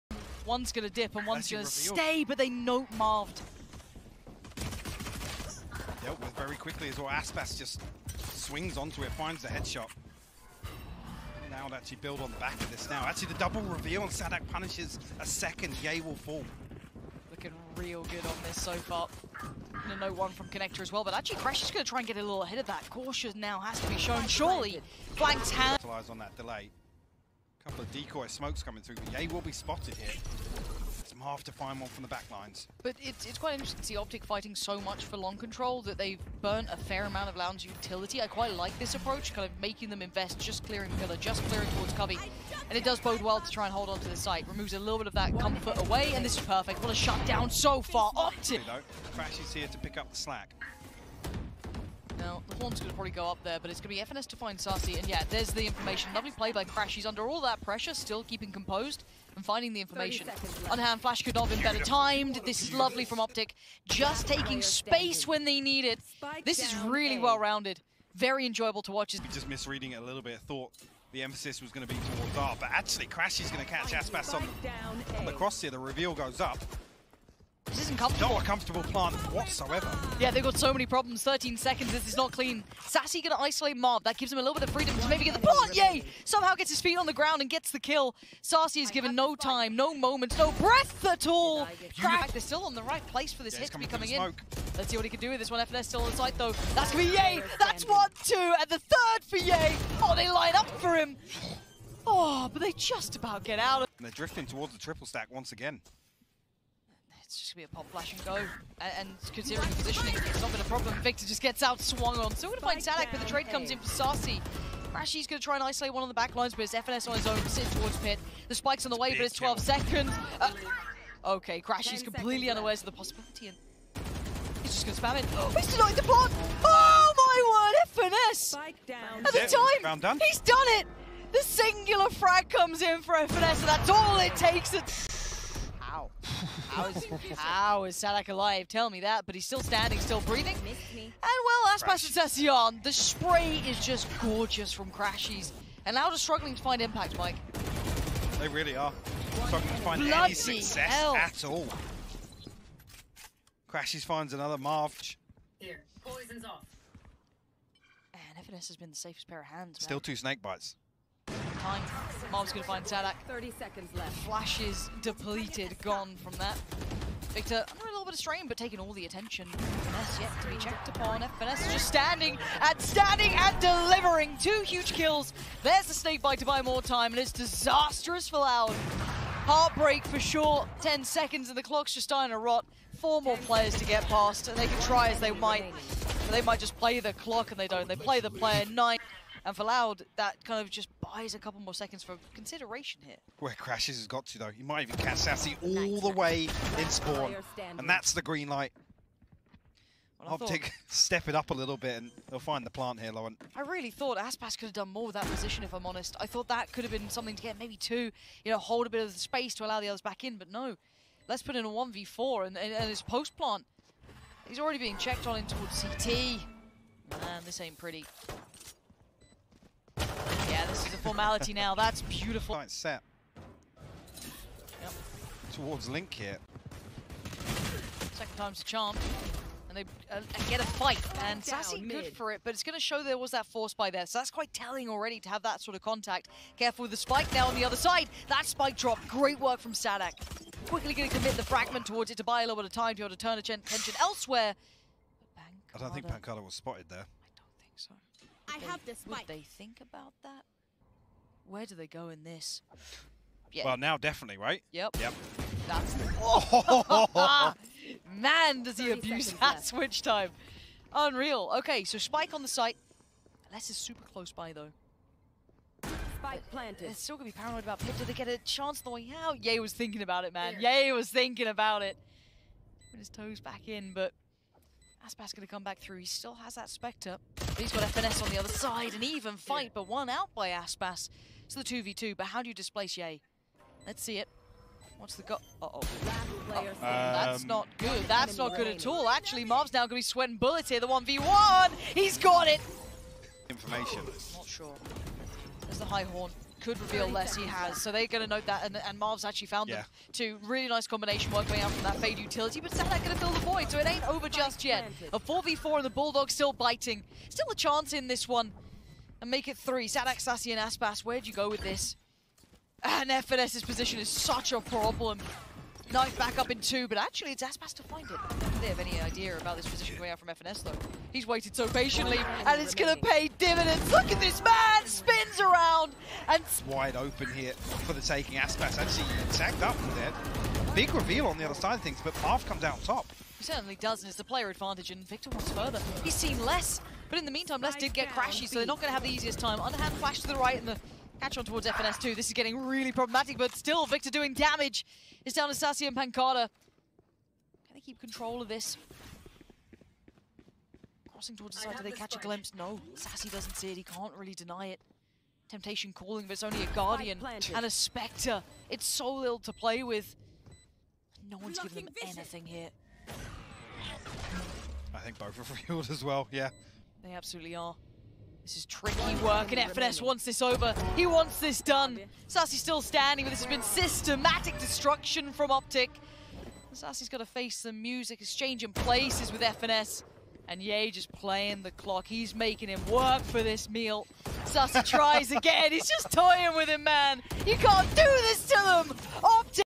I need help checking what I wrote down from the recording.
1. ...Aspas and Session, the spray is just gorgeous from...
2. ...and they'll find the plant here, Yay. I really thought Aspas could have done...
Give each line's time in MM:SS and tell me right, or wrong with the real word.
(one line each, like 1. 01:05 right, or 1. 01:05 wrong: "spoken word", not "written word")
1. 02:21 right
2. 03:21 wrong: "Lauren", not "Yay".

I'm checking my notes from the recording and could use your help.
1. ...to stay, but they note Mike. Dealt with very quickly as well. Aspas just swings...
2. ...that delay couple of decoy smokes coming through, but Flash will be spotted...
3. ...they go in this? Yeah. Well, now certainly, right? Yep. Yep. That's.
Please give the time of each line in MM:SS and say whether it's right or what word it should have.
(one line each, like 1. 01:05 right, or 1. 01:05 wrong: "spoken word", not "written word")
1. 00:01 wrong: "Marved", not "Mike"
2. 00:26 wrong: "Yay", not "Flash"
3. 04:11 wrong: "definitely", not "certainly".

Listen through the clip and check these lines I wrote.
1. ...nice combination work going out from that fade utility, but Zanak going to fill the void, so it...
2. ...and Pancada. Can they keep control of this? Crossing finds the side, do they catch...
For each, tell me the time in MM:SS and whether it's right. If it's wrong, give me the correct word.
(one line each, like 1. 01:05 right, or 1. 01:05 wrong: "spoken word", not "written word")
1. 05:00 right
2. 05:45 wrong: "towards", not "finds".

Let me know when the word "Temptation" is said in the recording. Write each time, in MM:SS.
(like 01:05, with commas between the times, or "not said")
05:55.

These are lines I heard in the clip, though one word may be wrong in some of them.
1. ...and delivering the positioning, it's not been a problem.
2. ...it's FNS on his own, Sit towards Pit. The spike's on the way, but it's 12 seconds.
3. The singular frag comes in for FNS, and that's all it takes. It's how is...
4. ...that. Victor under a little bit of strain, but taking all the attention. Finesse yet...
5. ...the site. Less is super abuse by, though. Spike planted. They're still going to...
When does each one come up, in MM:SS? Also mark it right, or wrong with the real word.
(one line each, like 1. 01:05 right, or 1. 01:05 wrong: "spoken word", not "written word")
1. 01:48 wrong: "considering", not "delivering"
2. 01:56 right
3. 02:11 right
4. 02:46 right
5. 04:22 wrong: "close", not "abuse".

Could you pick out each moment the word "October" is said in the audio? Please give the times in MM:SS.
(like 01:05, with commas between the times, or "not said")
not said.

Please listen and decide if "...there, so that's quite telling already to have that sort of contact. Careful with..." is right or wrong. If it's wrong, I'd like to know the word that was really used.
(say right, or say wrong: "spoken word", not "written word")
right.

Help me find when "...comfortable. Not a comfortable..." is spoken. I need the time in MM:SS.
01:17.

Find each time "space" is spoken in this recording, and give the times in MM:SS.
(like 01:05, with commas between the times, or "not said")
01:04, 03:29.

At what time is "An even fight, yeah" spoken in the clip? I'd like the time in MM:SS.
04:38.